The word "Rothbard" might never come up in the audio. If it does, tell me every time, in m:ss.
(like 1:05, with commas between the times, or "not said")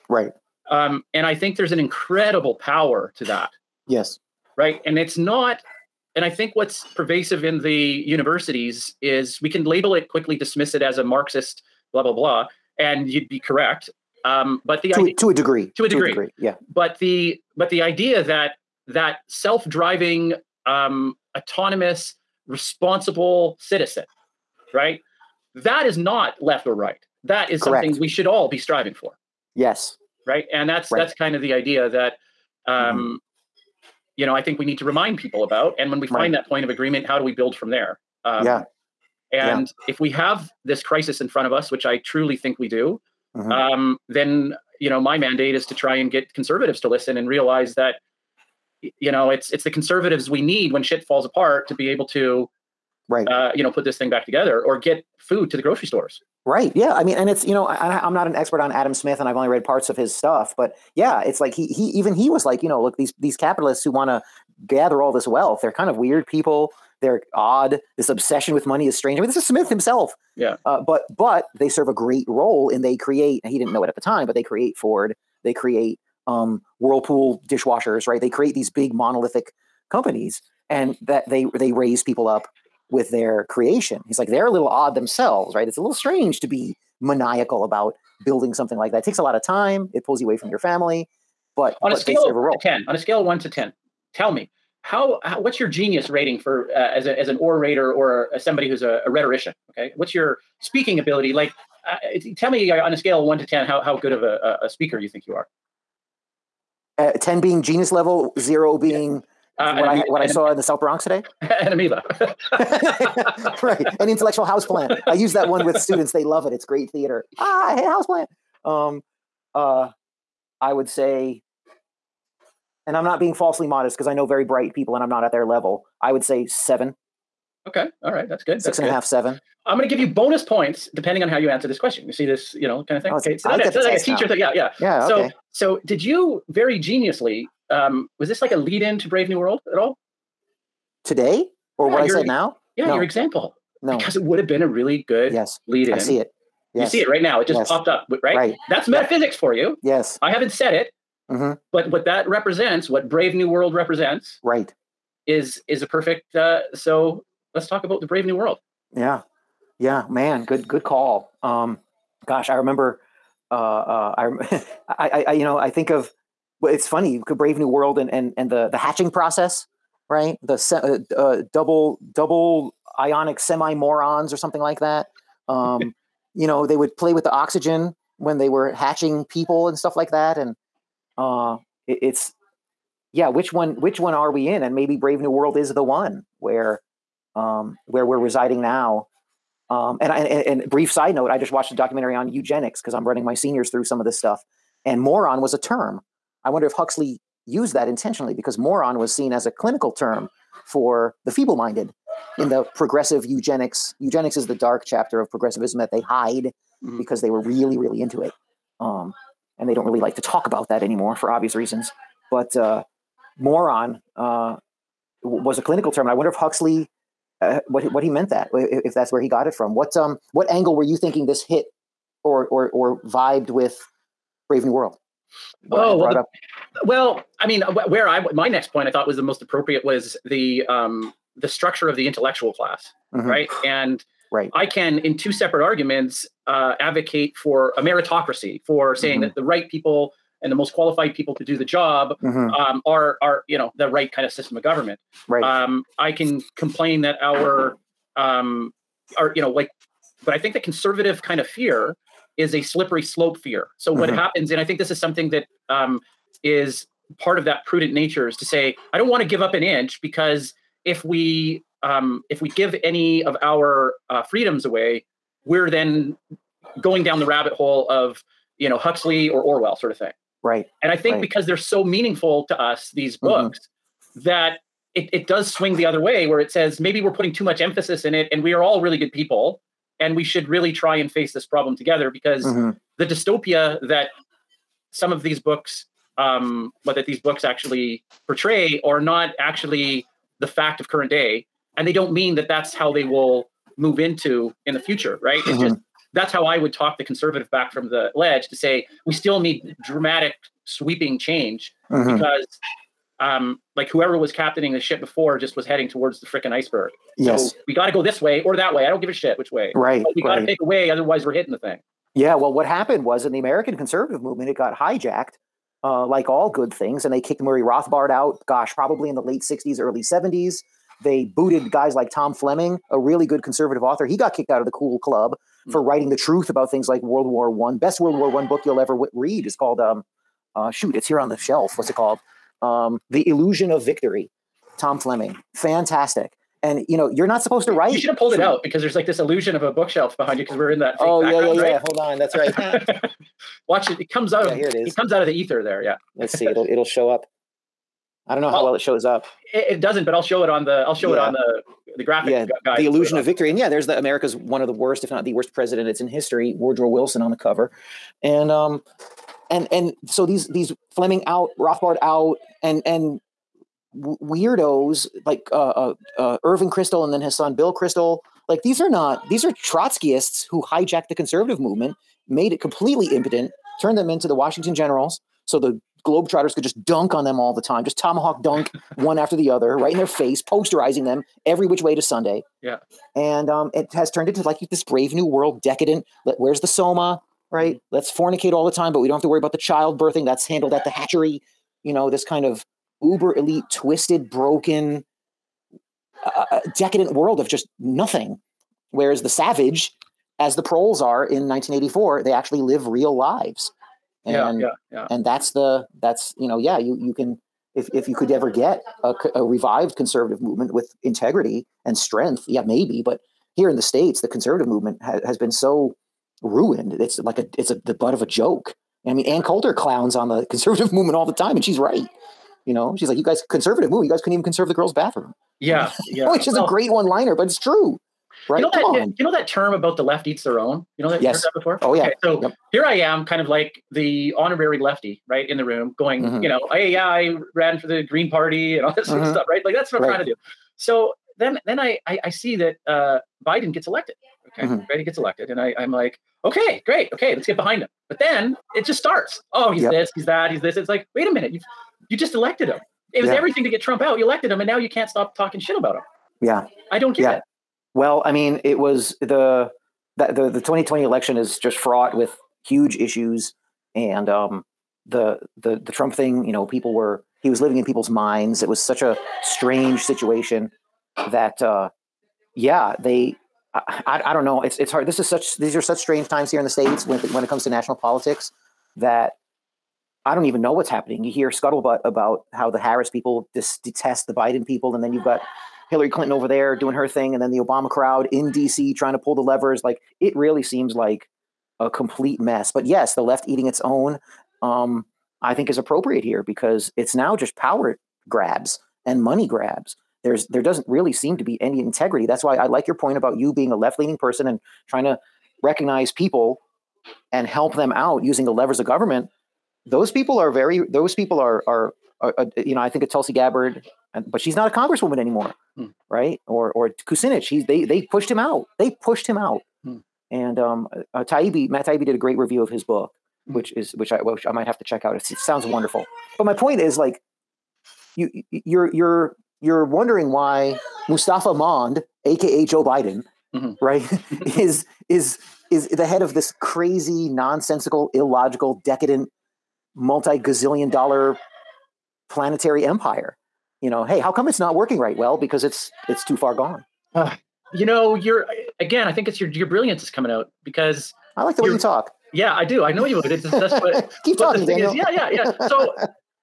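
5:17, 6:01.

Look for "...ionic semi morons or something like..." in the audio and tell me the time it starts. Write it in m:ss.
2:52.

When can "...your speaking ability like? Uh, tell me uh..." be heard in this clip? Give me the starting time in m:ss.
1:40.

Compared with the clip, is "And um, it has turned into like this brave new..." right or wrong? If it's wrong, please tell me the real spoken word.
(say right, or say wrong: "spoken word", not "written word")
right.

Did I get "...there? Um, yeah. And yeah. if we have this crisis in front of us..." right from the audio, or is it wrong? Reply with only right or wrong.
right.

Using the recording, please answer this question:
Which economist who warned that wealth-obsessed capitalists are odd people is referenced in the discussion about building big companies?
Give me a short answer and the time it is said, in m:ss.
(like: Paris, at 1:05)
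Adam Smith, at 0:58.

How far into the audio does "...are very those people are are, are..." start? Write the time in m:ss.
8:30.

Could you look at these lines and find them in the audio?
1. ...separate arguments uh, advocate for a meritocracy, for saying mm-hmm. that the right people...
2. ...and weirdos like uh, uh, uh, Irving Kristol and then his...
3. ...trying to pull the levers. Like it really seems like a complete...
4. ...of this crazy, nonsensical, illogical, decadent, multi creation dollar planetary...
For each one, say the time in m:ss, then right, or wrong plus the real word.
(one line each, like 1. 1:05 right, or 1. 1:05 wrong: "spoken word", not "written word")
1. 3:55 right
2. 6:02 right
3. 8:08 right
4. 8:56 wrong: "gazillion", not "creation".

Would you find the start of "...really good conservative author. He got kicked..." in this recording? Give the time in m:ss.
5:22.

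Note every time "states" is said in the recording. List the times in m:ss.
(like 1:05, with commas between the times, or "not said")
6:53, 7:56.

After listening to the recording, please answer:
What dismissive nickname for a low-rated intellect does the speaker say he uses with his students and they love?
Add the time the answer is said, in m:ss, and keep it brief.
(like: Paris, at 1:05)
An intellectual houseplant, at 1:53.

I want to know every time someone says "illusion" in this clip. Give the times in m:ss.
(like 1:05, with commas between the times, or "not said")
5:33, 5:39, 5:52.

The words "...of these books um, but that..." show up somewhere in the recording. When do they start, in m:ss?
4:45.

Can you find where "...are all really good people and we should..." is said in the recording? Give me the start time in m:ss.
4:38.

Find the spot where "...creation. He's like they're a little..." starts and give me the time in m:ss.
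1:23.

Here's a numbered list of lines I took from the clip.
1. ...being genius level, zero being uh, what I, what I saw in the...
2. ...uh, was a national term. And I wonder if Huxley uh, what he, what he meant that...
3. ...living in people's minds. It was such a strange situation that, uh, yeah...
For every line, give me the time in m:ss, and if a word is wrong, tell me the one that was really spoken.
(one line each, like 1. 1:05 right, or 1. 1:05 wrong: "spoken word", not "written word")
1. 1:47 right
2. 3:34 wrong: "clinical", not "national"
3. 7:47 right.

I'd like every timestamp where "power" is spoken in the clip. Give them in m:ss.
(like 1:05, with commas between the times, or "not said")
0:02, 8:17.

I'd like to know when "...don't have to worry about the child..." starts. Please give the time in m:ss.
6:29.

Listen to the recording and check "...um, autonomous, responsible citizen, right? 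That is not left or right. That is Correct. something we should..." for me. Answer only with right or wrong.
right.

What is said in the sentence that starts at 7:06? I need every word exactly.
Which is well, a great one-liner, but it's true.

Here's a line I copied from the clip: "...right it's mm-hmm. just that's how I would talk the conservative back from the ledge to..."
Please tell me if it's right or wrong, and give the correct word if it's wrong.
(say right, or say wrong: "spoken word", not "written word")
right.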